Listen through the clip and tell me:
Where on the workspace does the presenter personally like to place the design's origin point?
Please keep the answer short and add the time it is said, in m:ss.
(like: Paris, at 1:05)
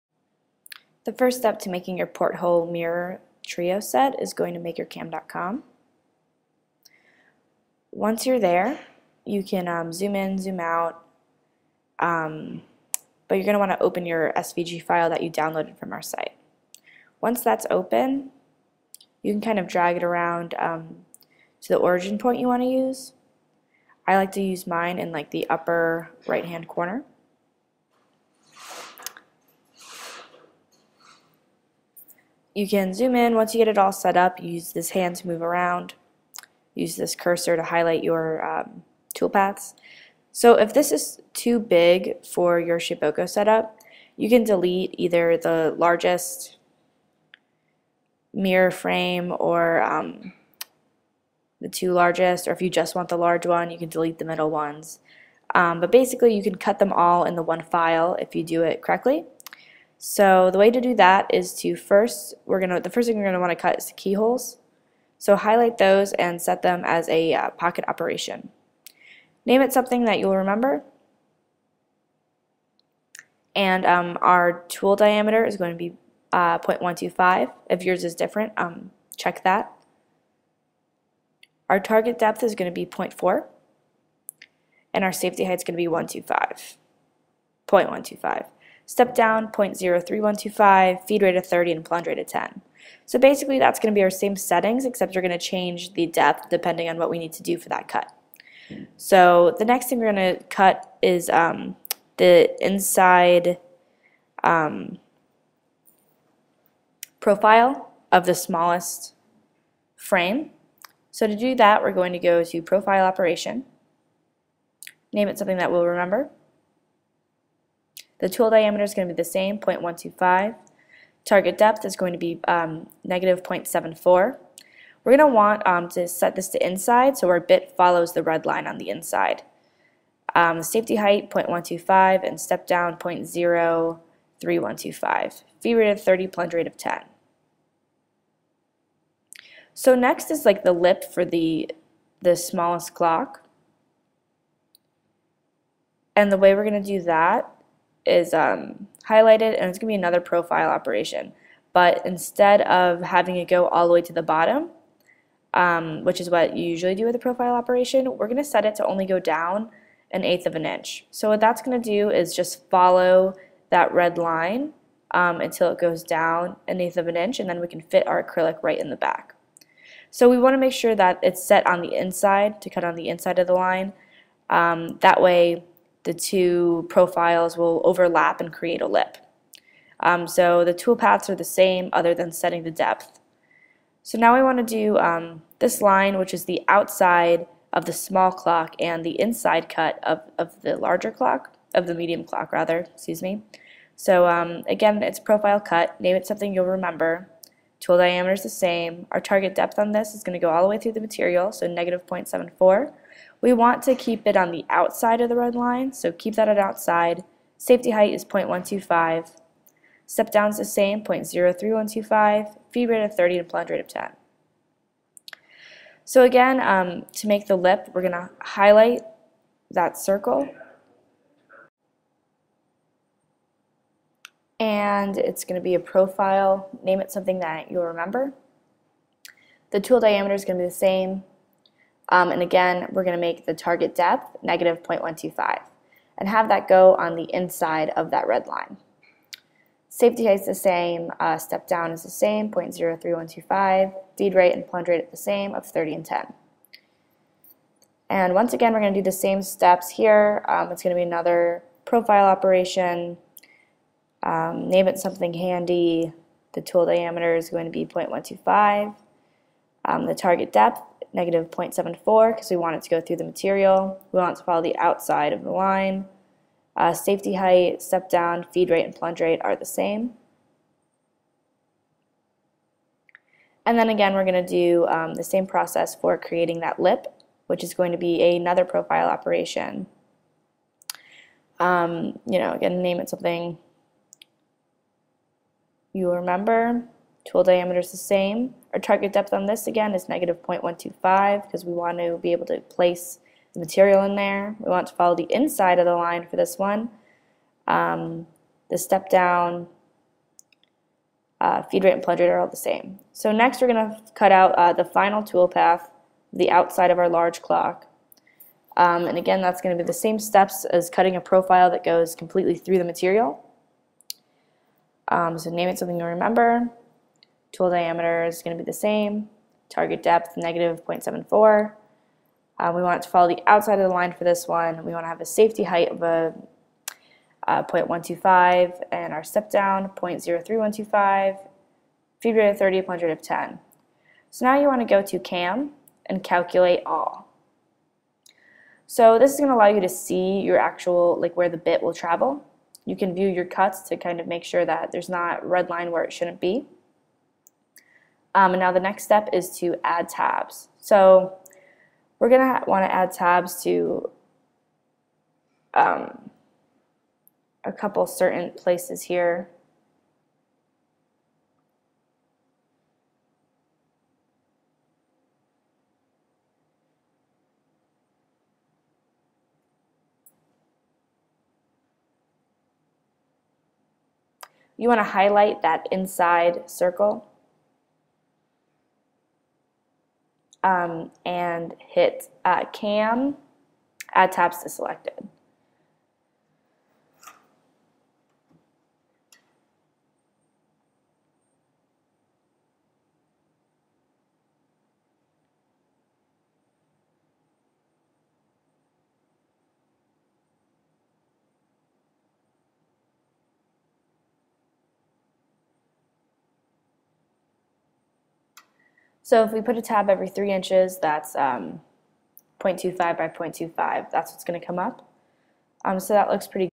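upper right hand corner, at 0:25.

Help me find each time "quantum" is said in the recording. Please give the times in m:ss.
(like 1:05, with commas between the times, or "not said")
not said.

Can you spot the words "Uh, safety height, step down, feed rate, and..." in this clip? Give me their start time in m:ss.
4:26.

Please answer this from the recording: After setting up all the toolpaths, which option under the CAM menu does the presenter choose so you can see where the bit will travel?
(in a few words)
calculate all.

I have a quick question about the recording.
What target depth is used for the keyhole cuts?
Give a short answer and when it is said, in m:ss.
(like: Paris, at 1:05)
0.4, at 1:22.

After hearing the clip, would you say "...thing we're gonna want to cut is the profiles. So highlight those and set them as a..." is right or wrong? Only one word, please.
wrong.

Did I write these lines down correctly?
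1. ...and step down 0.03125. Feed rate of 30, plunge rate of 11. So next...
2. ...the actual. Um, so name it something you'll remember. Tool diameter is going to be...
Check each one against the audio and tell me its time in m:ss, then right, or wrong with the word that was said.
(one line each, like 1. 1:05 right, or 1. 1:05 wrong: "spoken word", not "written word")
1. 2:12 wrong: "10", not "11"
2. 5:12 wrong: "material", not "actual".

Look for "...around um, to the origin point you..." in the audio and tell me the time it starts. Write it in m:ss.
0:20.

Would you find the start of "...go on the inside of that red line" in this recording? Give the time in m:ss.
3:56.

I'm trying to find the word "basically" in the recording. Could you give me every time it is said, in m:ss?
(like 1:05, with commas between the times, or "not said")
0:55, 1:33.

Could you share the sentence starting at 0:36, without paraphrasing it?
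Use this cursor to highlight your um, toolpaths.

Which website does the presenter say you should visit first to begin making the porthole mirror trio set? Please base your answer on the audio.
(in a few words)
makercam.com.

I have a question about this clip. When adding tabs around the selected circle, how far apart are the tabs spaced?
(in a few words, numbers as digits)
3 inches.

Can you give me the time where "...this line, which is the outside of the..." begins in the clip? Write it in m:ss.
3:05.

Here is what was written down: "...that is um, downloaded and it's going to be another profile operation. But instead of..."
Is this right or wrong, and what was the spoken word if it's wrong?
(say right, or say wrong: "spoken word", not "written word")
wrong: "highlighted", not "downloaded".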